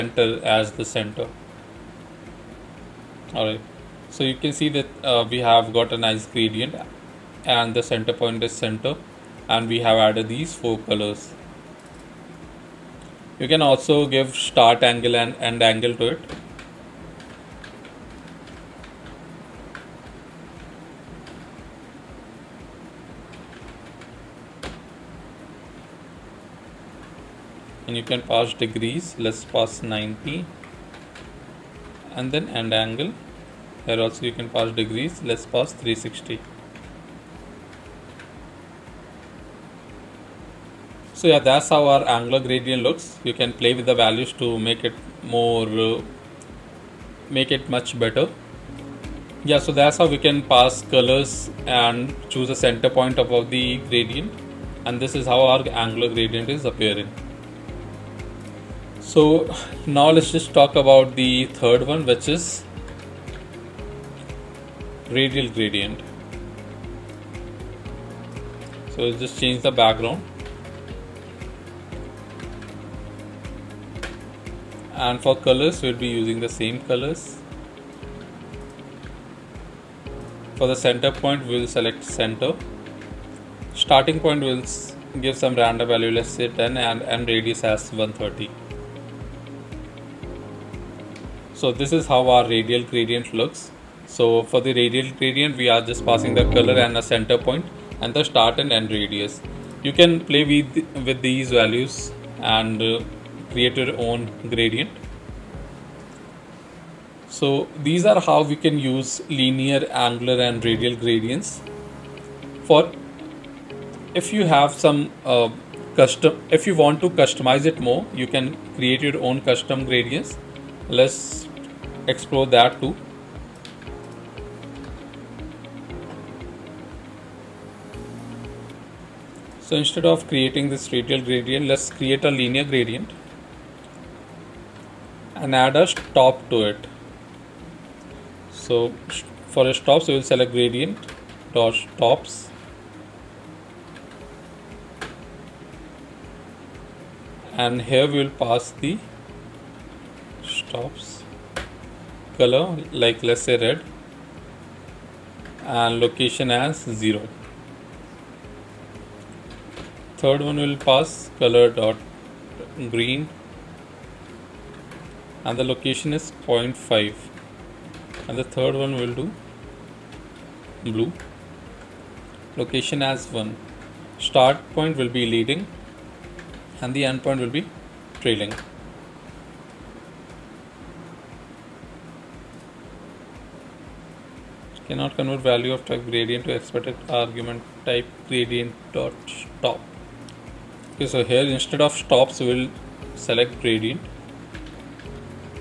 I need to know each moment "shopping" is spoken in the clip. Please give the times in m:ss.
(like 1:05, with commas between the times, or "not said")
not said.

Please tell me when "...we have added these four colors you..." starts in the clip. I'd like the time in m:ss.
0:09.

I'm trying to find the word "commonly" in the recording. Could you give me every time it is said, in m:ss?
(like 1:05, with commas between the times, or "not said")
not said.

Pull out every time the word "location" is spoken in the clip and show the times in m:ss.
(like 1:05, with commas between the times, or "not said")
2:36, 2:45, 2:52.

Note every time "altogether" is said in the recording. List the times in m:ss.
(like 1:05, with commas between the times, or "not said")
not said.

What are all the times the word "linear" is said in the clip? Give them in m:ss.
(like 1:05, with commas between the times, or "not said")
1:49, 2:12.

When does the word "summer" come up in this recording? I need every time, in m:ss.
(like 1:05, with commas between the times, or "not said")
not said.